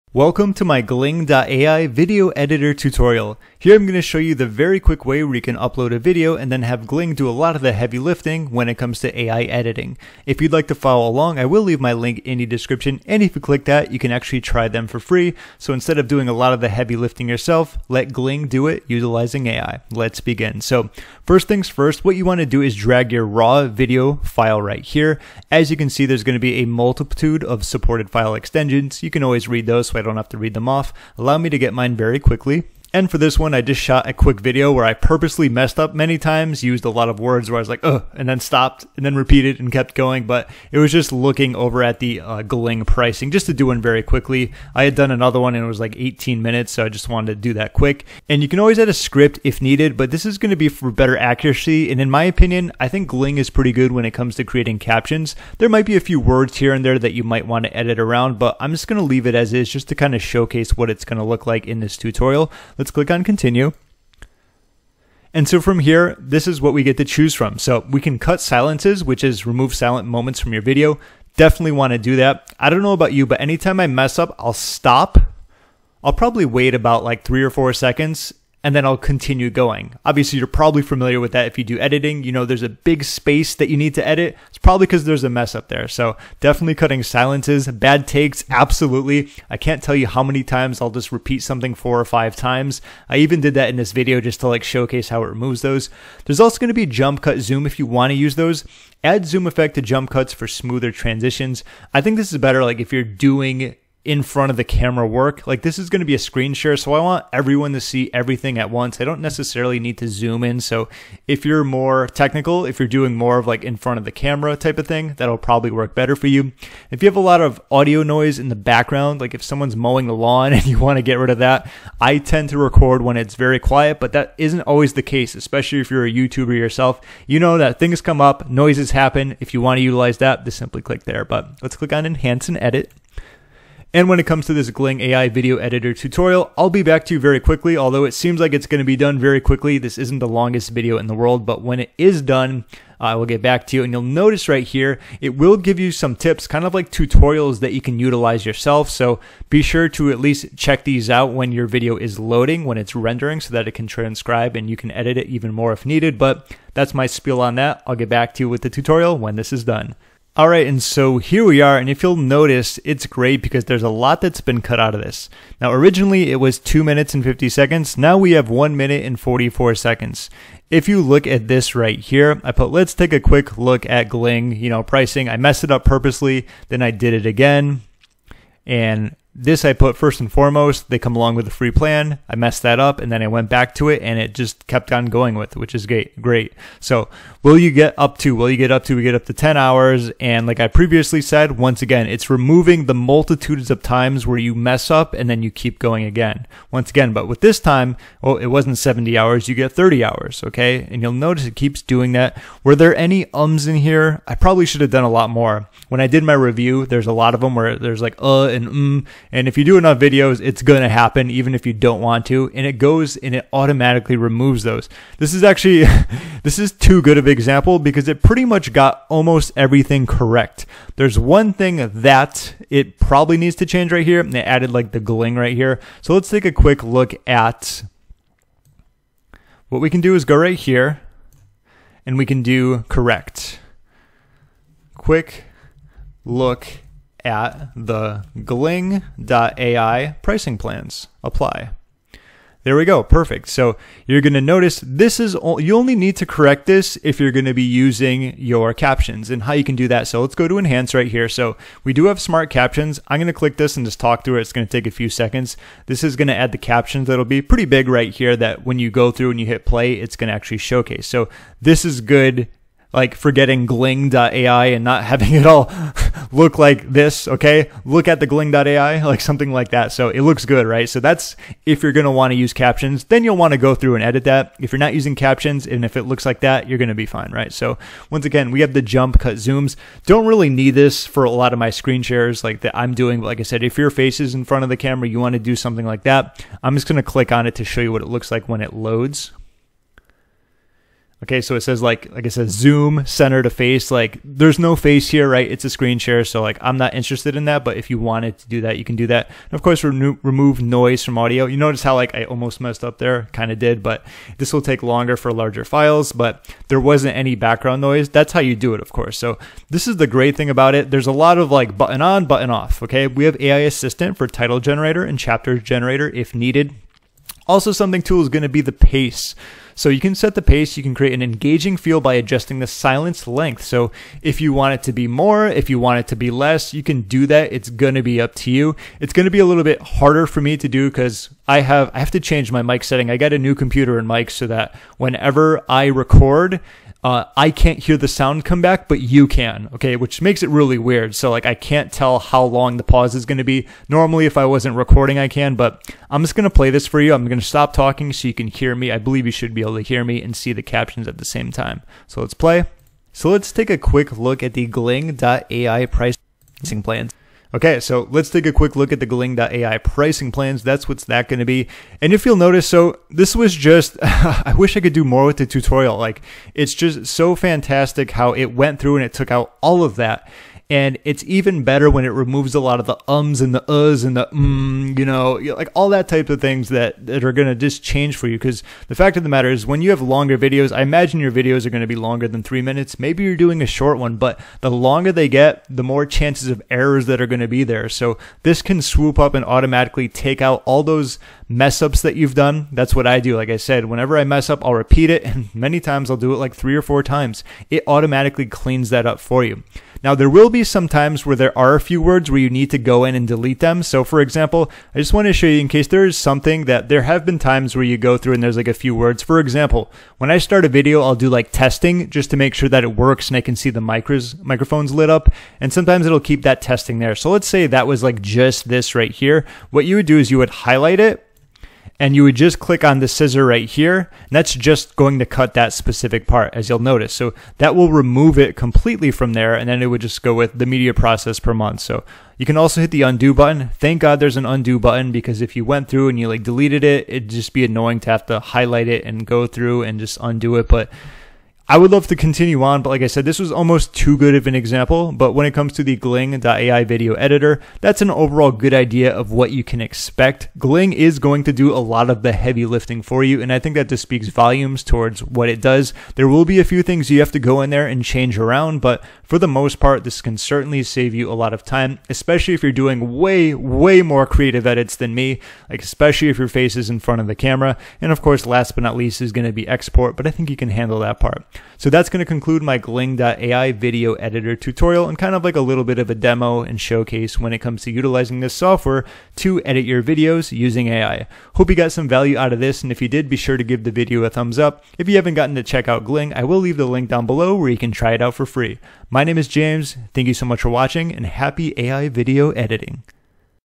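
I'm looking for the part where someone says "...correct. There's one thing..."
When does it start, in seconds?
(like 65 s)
220 s.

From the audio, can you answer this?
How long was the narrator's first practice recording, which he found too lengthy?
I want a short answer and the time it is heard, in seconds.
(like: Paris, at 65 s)
18 minutes, at 45 s.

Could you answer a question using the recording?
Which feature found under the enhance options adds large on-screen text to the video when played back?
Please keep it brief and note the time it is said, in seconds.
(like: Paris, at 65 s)
Smart captions, at 252 s.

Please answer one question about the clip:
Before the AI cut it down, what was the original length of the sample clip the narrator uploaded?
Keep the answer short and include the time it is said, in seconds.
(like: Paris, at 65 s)
2 minutes and 50 seconds, at 166 s.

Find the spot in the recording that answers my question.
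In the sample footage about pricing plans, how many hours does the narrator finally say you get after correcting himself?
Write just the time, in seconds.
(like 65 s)
199 s.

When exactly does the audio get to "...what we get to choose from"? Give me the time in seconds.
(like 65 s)
66 s.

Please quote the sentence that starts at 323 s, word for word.
So if you want it to be more, if you want it to be less, you can do that.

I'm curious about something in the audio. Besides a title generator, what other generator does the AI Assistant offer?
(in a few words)
Chapter generator.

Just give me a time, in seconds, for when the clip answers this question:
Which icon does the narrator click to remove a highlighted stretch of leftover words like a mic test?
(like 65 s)
423 s.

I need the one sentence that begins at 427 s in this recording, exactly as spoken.
So that will remove it completely from there, and then it would just go with the media process per month.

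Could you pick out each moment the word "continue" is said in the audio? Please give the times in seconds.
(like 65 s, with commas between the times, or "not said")
63 s, 78 s, 442 s.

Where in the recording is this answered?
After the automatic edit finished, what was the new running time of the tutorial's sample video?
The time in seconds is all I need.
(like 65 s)
168 s.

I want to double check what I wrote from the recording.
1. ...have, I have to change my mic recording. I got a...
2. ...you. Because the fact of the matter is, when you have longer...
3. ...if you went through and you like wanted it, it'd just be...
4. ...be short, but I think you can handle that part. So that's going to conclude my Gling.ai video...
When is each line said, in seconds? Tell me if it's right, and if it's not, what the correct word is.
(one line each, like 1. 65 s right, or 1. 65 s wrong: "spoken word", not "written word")
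1. 331 s wrong: "setting", not "recording"
2. 378 s right
3. 435 s wrong: "deleted", not "wanted"
4. 469 s wrong: "export", not "short".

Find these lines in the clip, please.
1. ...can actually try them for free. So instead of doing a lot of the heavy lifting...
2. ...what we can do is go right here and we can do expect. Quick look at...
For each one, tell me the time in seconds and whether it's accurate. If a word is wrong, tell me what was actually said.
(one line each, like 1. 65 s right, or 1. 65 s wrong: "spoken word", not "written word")
1. 13 s right
2. 229 s wrong: "correct", not "expect".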